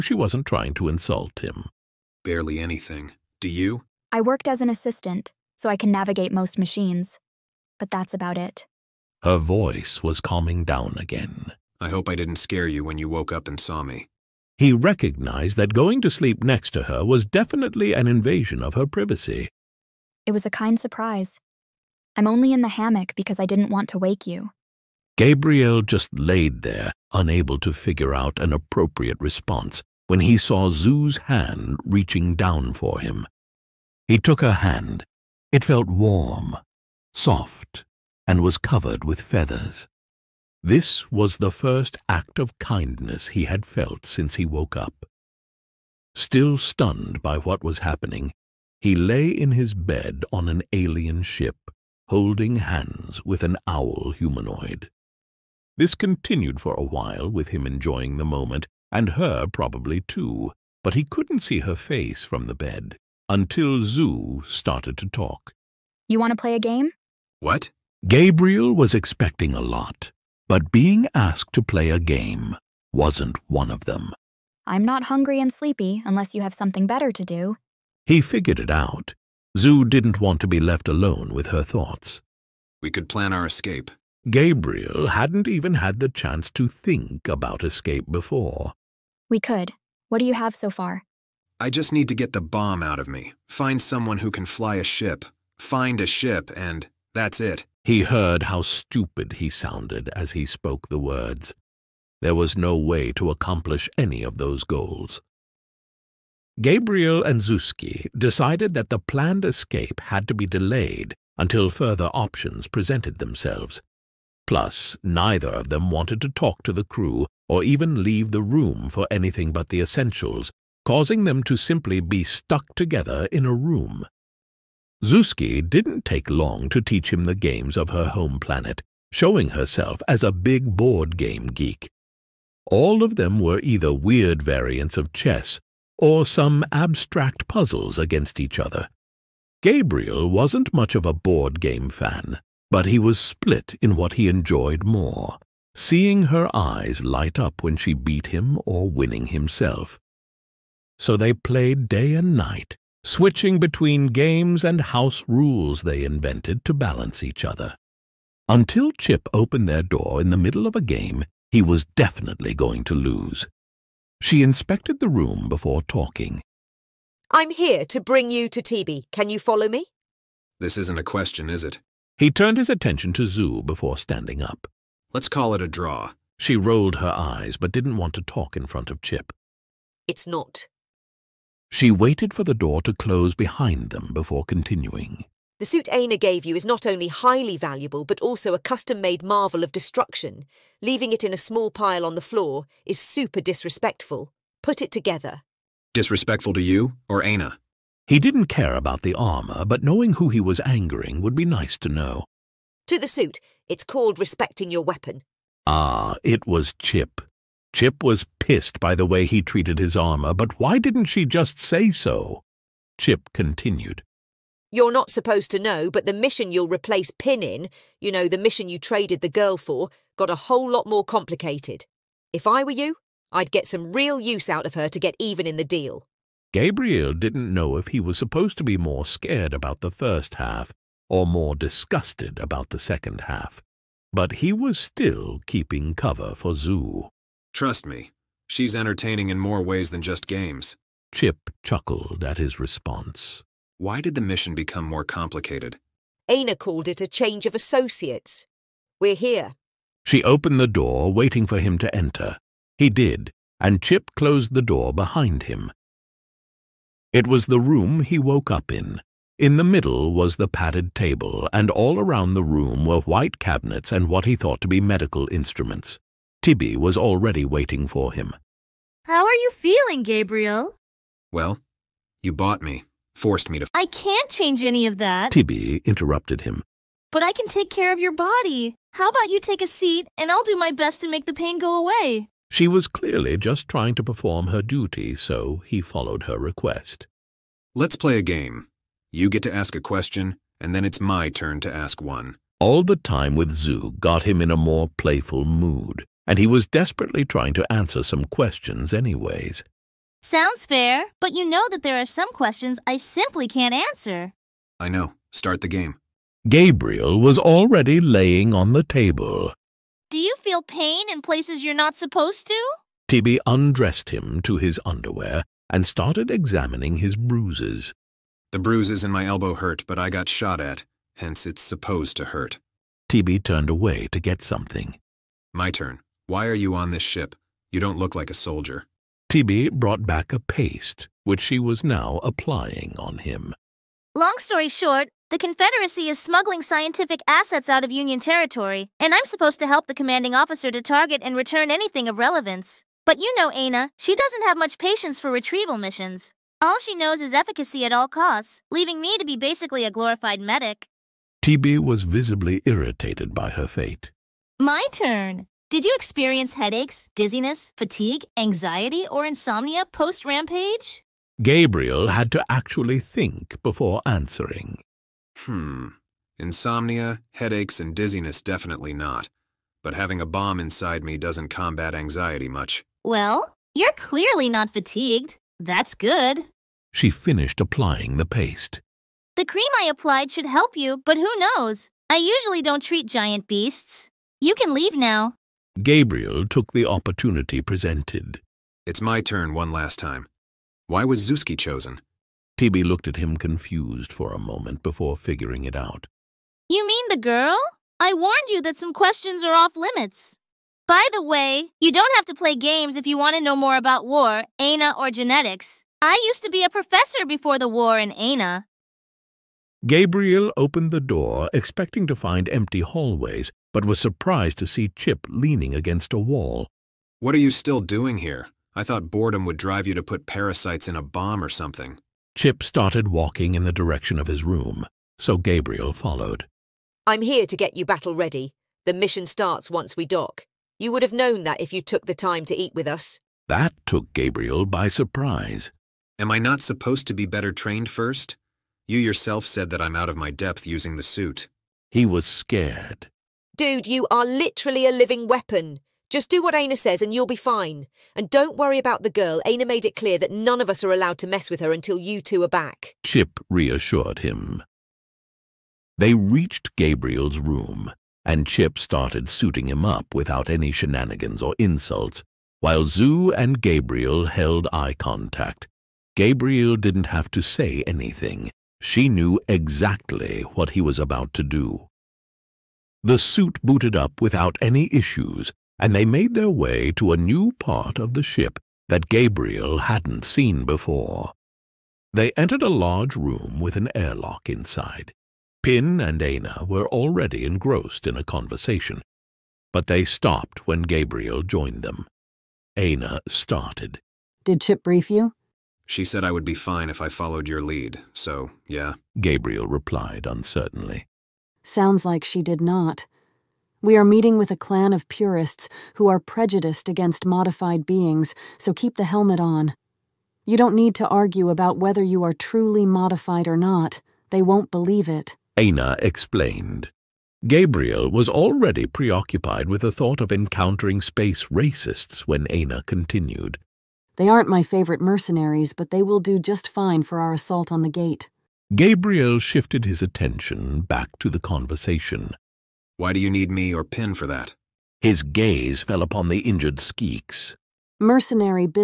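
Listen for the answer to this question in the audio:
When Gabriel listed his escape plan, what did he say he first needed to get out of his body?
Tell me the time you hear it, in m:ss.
1:32.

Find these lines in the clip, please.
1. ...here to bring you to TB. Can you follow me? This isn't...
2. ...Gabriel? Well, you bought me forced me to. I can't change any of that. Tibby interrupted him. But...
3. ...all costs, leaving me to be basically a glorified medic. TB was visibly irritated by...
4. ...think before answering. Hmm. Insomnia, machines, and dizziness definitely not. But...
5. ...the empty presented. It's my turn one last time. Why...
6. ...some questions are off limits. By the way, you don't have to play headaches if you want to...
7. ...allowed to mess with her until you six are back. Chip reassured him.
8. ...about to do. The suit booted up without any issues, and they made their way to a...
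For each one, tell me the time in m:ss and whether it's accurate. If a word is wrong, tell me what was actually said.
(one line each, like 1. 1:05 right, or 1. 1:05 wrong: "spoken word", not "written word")
1. 2:47 right
2. 4:30 right
3. 5:47 right
4. 6:02 wrong: "headaches", not "machines"
5. 6:26 wrong: "opportunity", not "empty"
6. 6:38 wrong: "games", not "headaches"
7. 7:30 wrong: "two", not "six"
8. 7:50 right.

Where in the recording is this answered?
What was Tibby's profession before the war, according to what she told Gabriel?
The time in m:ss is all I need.
6:46.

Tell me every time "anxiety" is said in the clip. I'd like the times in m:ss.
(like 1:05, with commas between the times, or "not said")
5:58, 6:11.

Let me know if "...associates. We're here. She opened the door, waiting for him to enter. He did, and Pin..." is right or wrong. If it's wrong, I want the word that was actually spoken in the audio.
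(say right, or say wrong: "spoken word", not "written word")
wrong: "Chip", not "Pin".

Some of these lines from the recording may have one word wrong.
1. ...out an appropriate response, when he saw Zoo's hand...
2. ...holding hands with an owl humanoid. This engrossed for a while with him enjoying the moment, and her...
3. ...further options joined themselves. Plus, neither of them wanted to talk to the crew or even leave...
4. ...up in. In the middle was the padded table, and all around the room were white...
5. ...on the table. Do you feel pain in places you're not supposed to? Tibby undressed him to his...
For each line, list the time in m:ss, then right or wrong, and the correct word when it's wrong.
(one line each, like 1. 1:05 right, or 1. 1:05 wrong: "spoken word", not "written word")
1. 0:28 right
2. 0:52 wrong: "continued", not "engrossed"
3. 1:51 wrong: "presented", not "joined"
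4. 4:18 right
5. 5:08 right.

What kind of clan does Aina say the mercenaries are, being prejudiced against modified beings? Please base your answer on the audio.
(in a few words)
purists.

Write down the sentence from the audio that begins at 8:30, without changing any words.
You don't need to argue about whether you are truly modified or not.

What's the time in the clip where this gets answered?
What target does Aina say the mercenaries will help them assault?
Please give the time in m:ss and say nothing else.
8:47.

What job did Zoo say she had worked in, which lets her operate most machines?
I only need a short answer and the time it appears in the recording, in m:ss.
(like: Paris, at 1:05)
assistant, at 0:04.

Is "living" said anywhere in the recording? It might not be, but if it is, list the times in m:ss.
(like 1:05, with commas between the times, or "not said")
7:24.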